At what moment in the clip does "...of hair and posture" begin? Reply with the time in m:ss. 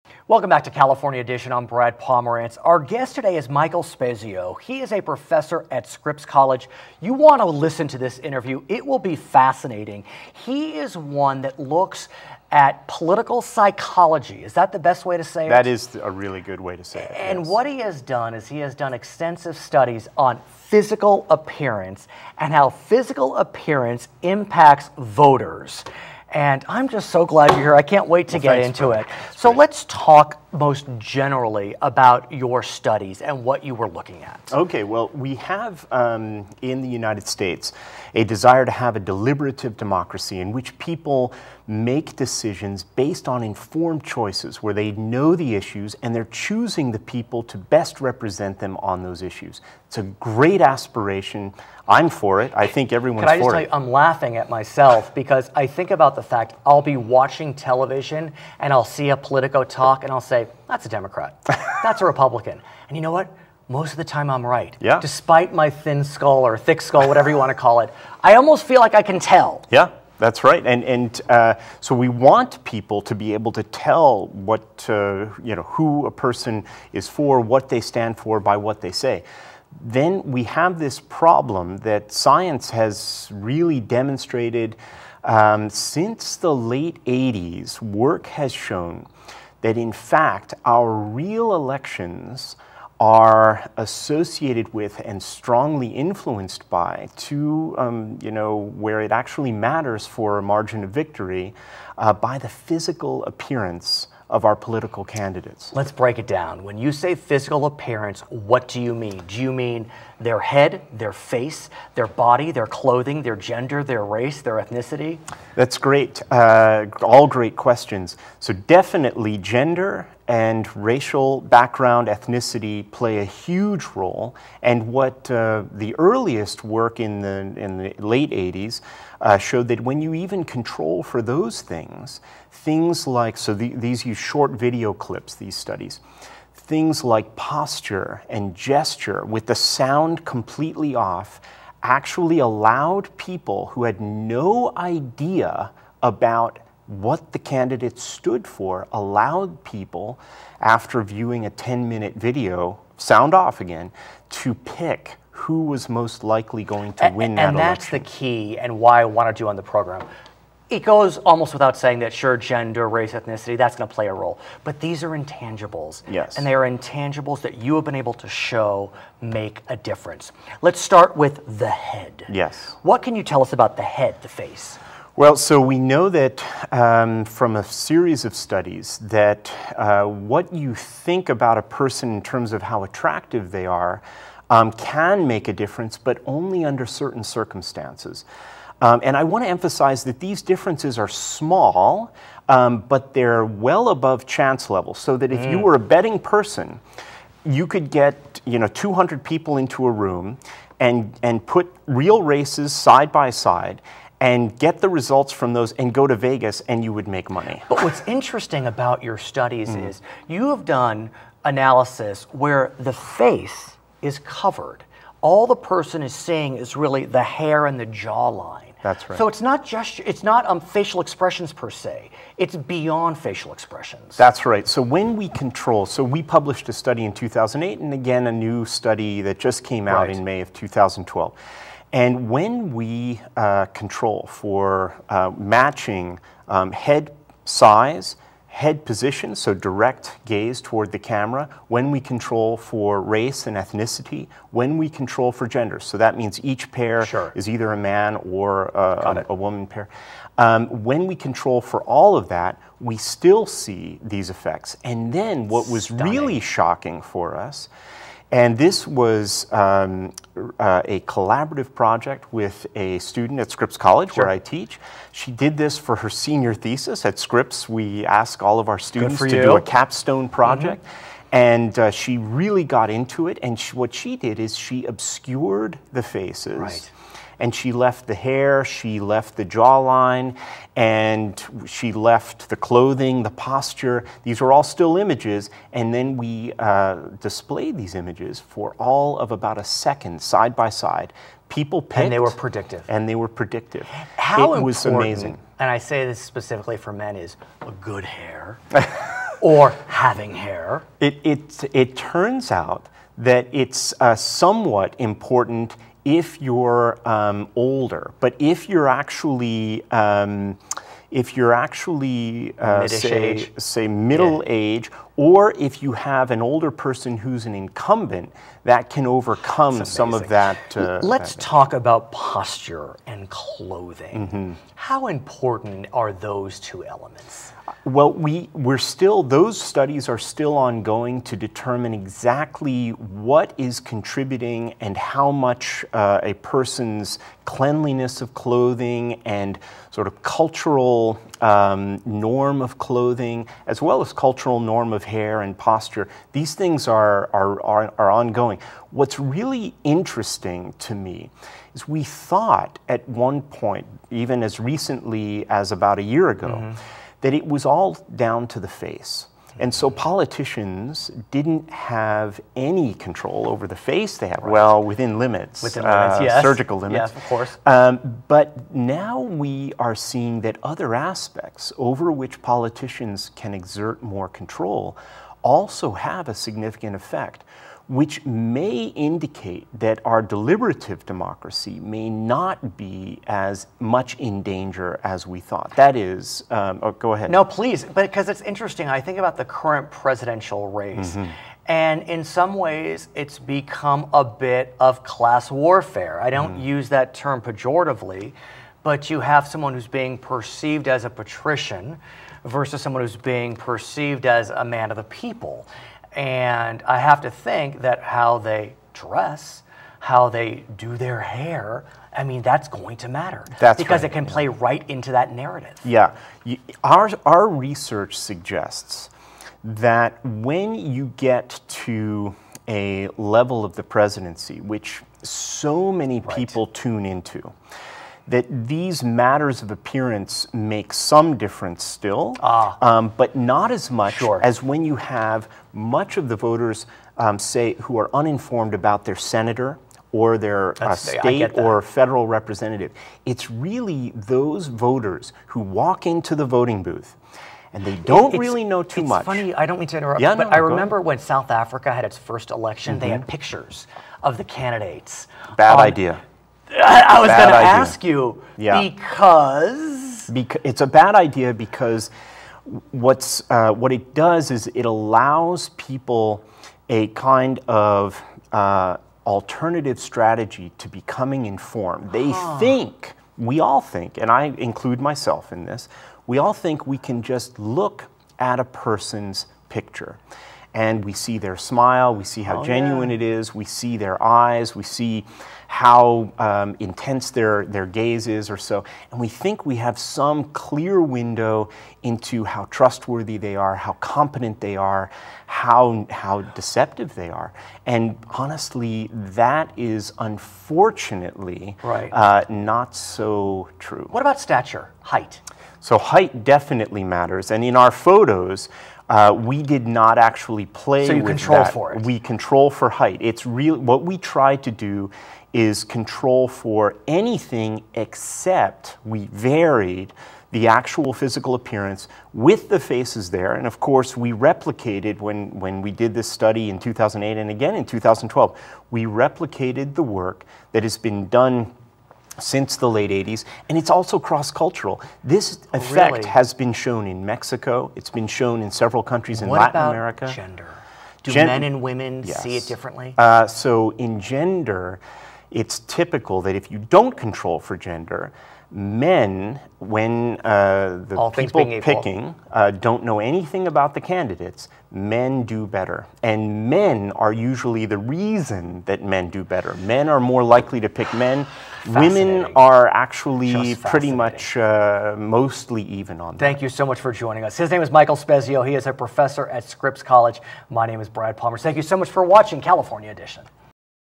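5:44.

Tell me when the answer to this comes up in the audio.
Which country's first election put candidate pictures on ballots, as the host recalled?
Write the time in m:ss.
7:31.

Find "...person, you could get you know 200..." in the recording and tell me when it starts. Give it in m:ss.
3:16.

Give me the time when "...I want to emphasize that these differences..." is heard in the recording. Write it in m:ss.
3:09.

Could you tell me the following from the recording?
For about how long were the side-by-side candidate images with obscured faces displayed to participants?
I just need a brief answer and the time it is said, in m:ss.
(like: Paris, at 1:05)
about a second, at 4:49.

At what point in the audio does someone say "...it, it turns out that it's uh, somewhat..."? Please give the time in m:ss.
5:01.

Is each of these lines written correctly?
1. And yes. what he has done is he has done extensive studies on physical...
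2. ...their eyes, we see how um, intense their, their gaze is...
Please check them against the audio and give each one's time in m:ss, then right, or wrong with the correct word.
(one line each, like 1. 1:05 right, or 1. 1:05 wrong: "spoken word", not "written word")
1. 0:17 right
2. 8:03 right.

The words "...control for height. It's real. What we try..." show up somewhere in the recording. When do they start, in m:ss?
8:32.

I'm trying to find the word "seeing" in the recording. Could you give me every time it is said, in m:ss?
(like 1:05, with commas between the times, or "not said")
3:36, 6:09.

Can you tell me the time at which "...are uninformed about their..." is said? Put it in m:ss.
7:17.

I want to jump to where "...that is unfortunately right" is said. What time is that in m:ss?
8:19.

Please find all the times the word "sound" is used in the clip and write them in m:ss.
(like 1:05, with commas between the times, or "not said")
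2:19, 2:32.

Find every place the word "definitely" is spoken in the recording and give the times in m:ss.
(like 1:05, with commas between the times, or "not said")
1:58, 8:26.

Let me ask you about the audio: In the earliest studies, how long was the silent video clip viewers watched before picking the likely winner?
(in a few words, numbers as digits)
10 minutes.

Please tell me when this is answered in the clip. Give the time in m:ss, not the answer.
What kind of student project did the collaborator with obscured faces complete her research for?
4:26.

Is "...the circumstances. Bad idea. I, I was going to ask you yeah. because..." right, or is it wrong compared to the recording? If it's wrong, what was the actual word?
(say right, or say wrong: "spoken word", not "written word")
wrong: "candidates", not "circumstances".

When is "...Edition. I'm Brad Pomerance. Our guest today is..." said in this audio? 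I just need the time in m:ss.
0:01.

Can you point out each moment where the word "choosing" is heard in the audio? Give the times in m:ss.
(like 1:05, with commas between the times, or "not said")
0:46.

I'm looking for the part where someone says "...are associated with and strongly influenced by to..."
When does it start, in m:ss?
1:32.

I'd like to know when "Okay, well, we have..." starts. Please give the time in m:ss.
0:34.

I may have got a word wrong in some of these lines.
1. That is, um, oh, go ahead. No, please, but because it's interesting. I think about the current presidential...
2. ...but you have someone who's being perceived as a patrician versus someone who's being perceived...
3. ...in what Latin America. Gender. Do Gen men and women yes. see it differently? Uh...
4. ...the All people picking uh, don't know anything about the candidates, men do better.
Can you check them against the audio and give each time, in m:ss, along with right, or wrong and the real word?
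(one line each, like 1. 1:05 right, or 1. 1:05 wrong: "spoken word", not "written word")
1. 6:25 right
2. 6:38 right
3. 8:59 right
4. 9:11 right.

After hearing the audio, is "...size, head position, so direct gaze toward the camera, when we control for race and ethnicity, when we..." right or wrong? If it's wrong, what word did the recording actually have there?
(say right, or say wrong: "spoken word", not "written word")
right.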